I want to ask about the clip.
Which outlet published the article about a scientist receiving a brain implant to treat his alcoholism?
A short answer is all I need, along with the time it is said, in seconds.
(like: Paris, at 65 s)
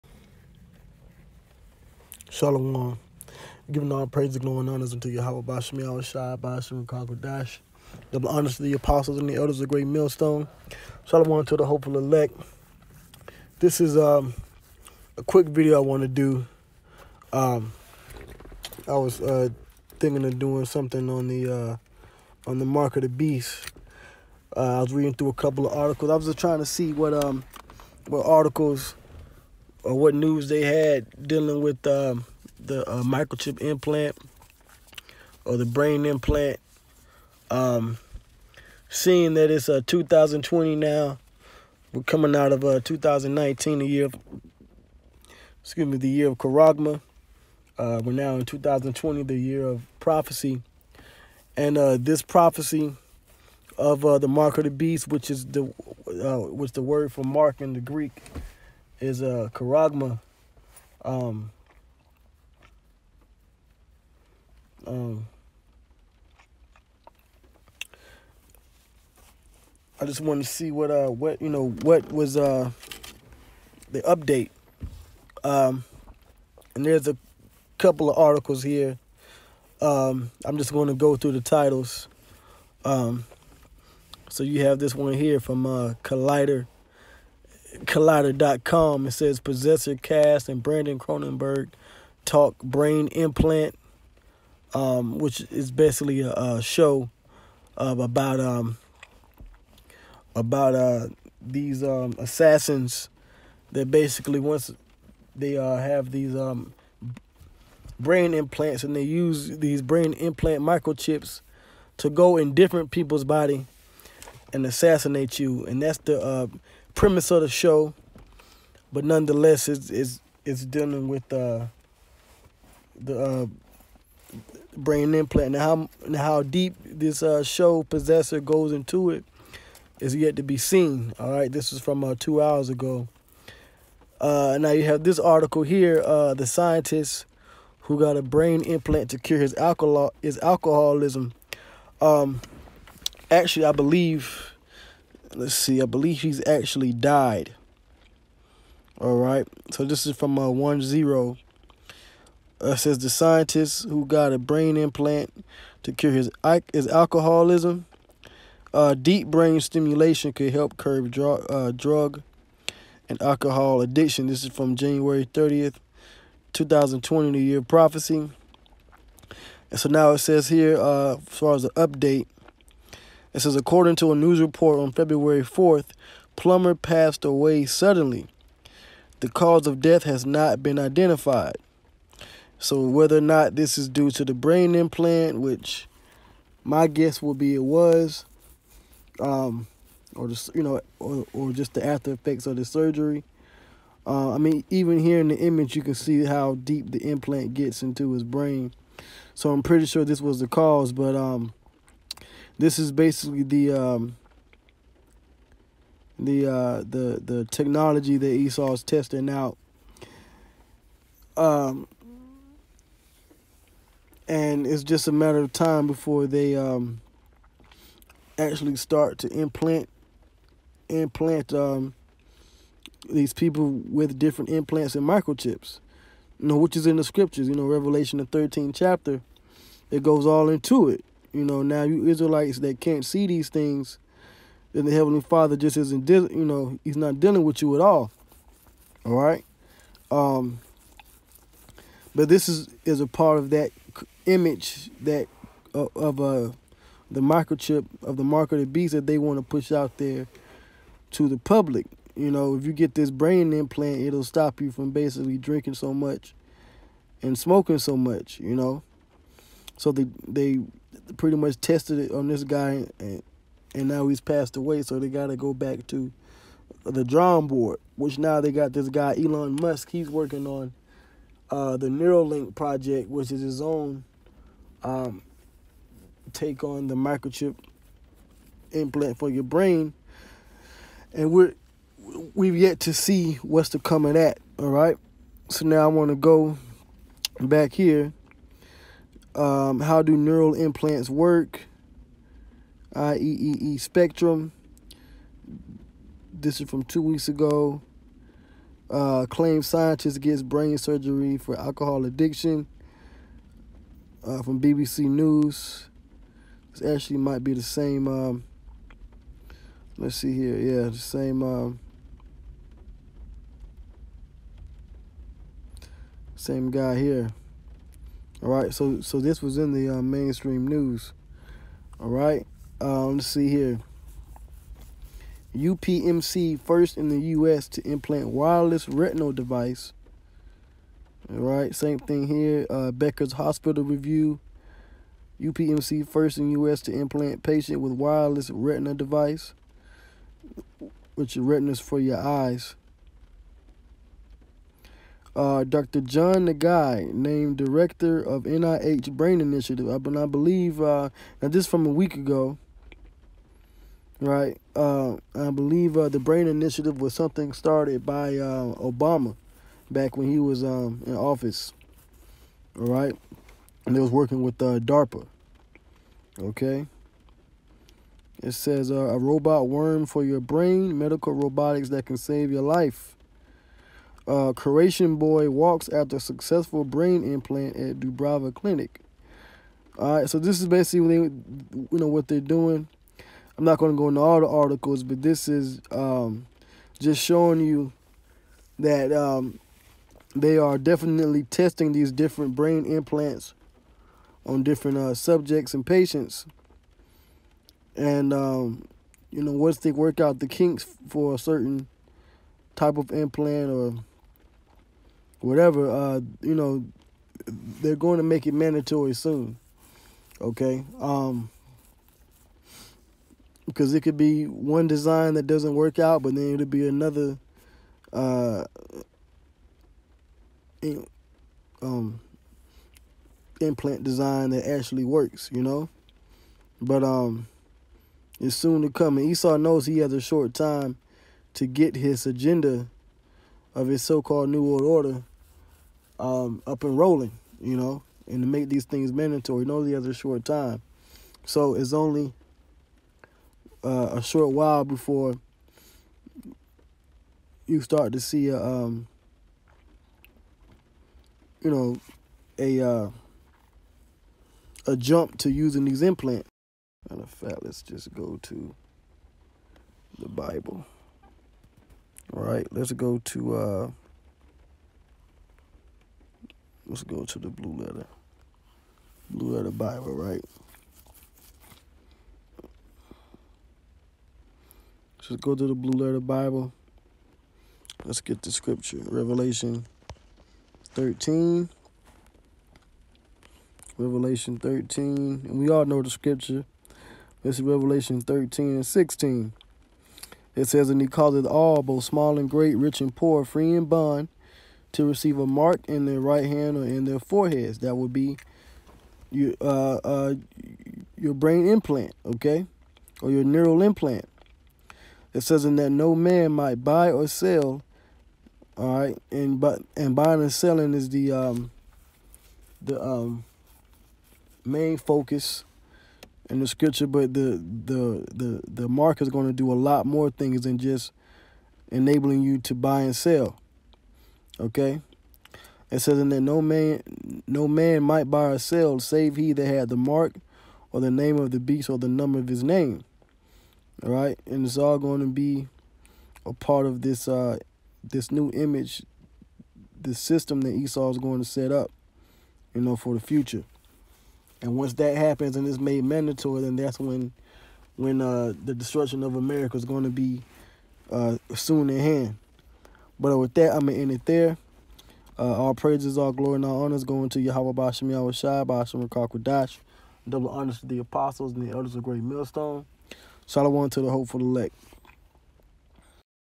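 OneZero, at 150 s.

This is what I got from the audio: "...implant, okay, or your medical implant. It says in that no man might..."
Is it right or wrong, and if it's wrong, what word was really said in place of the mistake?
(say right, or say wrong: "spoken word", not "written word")
wrong: "neural", not "medical".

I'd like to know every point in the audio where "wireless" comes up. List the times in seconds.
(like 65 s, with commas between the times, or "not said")
328 s, 337 s.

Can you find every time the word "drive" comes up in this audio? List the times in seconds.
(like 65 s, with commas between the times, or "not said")
not said.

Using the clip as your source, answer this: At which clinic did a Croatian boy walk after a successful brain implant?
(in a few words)
Dubrava Clinic.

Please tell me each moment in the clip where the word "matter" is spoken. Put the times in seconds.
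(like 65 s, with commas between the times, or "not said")
215 s, 457 s.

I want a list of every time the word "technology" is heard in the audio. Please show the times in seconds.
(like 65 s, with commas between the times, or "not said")
207 s.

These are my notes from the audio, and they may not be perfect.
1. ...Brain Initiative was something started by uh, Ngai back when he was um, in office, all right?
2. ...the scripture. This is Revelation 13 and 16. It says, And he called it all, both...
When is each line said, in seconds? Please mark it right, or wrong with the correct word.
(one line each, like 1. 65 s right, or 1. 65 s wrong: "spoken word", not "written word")
1. 356 s wrong: "Obama", not "Ngai"
2. 486 s right.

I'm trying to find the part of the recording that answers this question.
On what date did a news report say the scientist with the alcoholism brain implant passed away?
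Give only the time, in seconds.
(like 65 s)
174 s.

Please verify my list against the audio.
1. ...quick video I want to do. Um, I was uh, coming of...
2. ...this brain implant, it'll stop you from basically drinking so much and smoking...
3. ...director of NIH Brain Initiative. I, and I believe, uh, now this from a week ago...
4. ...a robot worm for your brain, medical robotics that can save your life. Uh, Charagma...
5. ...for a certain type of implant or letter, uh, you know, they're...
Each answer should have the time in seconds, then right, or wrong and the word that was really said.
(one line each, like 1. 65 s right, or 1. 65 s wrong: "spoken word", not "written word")
1. 15 s wrong: "thinking", not "coming"
2. 252 s right
3. 347 s right
4. 368 s wrong: "Croatian", not "Charagma"
5. 401 s wrong: "whatever", not "letter".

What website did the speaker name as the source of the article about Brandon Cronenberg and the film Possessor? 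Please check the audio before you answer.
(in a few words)
Collider.com.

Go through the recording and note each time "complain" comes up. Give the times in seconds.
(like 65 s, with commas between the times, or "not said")
not said.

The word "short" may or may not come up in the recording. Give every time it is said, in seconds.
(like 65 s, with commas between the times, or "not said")
430 s, 440 s, 444 s.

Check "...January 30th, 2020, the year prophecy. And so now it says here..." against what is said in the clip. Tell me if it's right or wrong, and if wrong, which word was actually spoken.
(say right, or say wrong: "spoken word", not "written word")
right.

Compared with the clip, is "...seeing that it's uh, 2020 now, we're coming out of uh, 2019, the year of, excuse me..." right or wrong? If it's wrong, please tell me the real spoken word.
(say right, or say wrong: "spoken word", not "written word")
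right.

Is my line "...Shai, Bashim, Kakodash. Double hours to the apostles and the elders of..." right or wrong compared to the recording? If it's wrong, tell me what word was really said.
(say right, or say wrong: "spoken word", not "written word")
wrong: "honors", not "hours".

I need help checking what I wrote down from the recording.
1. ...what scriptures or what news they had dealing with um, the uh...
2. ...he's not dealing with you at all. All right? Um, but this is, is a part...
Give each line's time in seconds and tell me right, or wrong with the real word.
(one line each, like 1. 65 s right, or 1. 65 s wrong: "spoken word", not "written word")
1. 28 s wrong: "articles", not "scriptures"
2. 236 s right.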